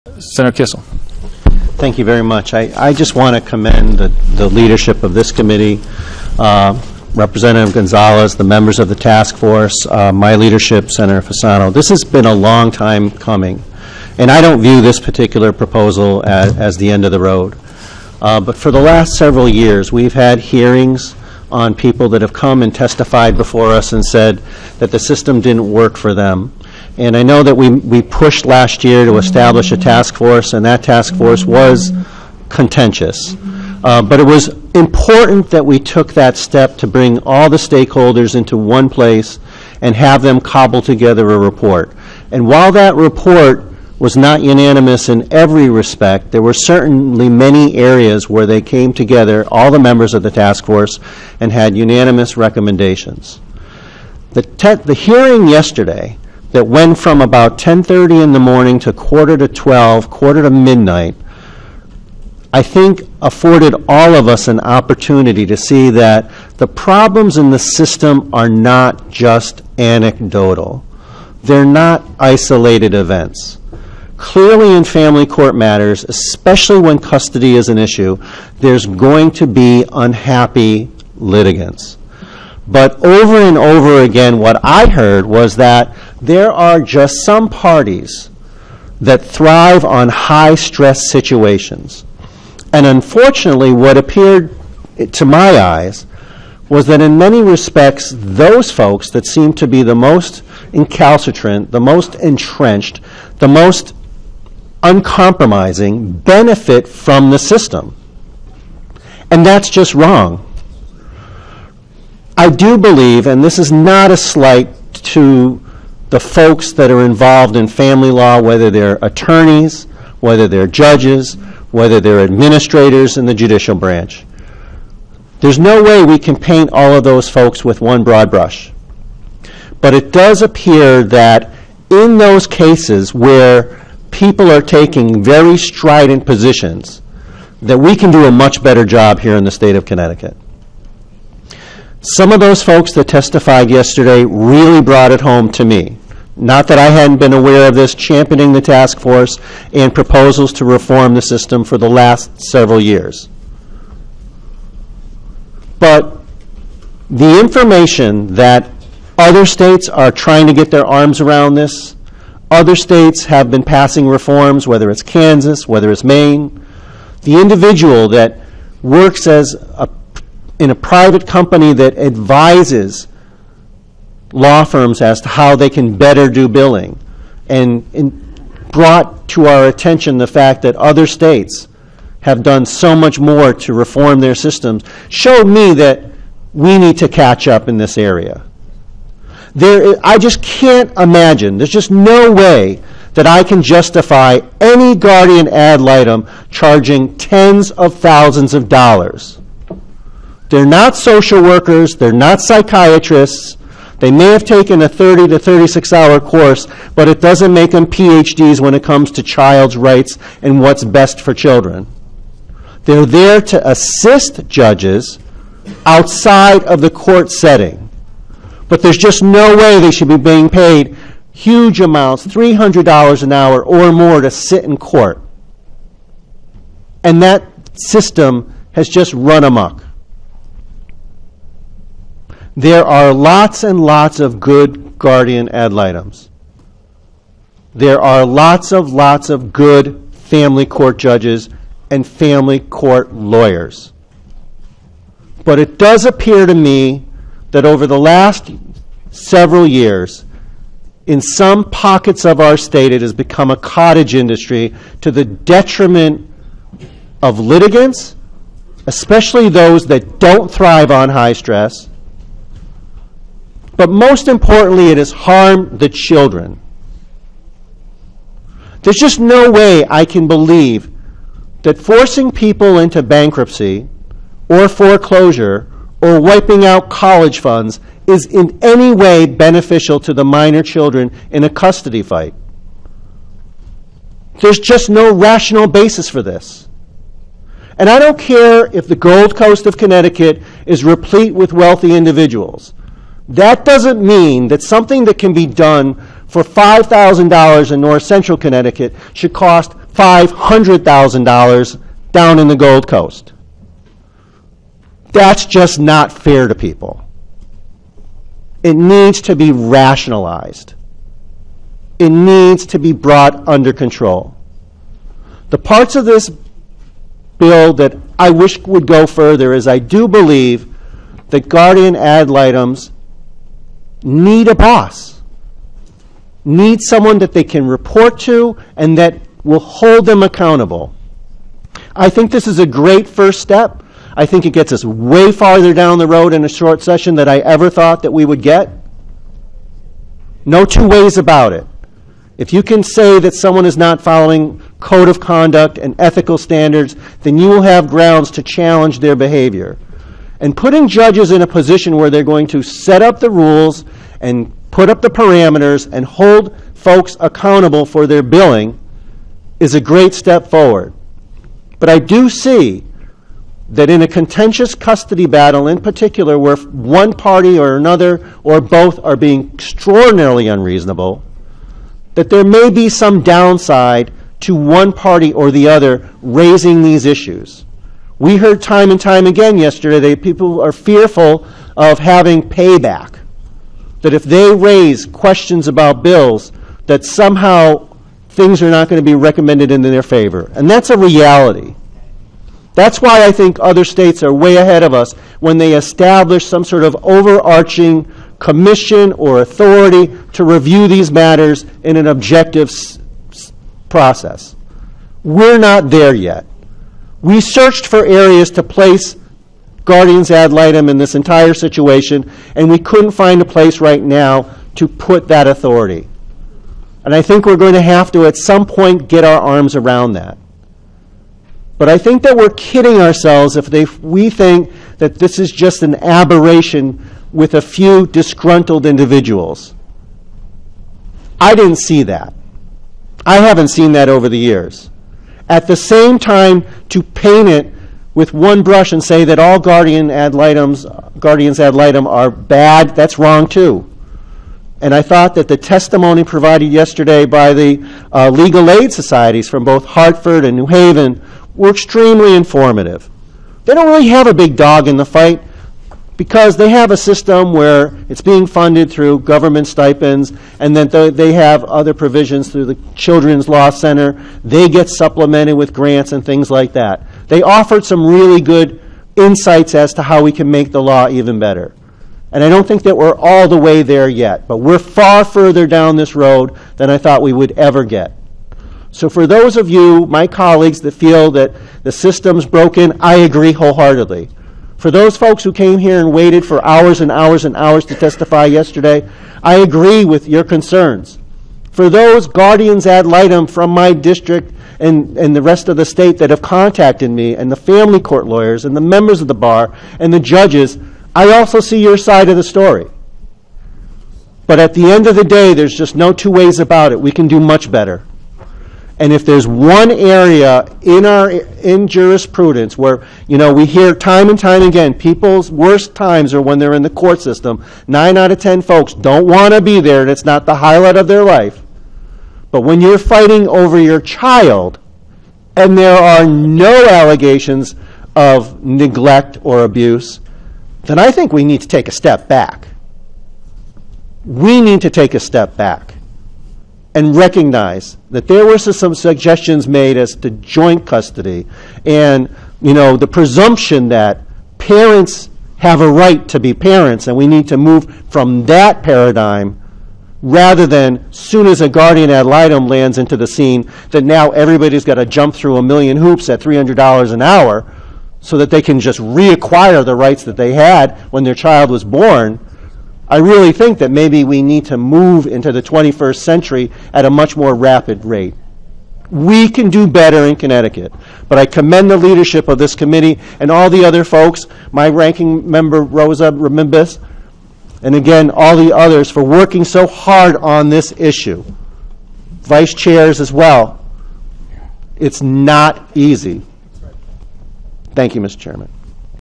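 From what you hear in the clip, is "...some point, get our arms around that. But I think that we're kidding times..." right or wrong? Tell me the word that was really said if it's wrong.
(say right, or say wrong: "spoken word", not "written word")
wrong: "ourselves", not "times".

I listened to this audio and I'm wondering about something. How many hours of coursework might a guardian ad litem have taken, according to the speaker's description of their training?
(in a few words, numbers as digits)
30 to 36 hours.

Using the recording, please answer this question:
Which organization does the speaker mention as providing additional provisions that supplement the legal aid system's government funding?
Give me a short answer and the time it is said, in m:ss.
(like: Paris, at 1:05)
Children's Law Center, at 7:42.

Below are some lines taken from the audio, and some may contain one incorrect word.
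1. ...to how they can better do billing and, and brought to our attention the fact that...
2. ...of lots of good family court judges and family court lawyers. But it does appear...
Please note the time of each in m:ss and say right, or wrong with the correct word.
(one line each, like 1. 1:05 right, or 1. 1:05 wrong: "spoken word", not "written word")
1. 2:55 right
2. 3:58 right.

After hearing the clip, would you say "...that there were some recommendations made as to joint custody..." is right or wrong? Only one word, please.
wrong.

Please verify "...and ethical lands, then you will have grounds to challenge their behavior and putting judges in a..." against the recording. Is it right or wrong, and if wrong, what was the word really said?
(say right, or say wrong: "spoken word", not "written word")
wrong: "standards", not "lands".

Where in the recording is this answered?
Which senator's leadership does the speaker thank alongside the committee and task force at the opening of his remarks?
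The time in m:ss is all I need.
0:10.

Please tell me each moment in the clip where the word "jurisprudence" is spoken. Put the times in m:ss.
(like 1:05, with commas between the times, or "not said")
8:31.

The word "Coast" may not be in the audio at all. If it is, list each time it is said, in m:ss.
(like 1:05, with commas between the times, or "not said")
4:49, 5:02.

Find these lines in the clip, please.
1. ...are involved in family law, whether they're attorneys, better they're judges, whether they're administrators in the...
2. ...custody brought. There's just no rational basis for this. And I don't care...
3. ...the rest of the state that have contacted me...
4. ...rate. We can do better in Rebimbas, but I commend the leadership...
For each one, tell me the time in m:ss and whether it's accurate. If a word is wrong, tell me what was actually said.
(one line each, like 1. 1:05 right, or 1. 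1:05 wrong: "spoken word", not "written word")
1. 1:56 wrong: "whether", not "better"
2. 4:41 wrong: "fight", not "brought"
3. 8:15 right
4. 9:28 wrong: "Connecticut", not "Rebimbas".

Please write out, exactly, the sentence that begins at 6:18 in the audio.
We heard time and time again yesterday that people are fearful of having payback.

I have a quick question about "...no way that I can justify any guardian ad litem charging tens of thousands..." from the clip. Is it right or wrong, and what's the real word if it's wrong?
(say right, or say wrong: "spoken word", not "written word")
right.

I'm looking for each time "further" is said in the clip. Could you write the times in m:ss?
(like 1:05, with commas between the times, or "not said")
5:19, 7:55.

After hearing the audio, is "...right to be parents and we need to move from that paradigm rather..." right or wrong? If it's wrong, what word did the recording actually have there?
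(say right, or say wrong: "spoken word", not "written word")
right.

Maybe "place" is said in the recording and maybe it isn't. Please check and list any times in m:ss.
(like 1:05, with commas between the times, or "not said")
0:38, 6:48, 6:53.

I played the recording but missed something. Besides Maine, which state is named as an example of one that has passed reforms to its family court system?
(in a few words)
Kansas.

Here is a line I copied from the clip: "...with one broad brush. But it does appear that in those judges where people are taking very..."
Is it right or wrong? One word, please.
wrong.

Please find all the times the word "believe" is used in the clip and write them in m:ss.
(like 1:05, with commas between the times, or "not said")
1:52, 4:30, 5:20.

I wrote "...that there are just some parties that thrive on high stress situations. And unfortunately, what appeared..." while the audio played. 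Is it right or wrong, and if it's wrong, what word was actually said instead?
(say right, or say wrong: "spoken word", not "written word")
right.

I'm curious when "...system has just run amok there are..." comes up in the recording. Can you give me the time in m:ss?
3:47.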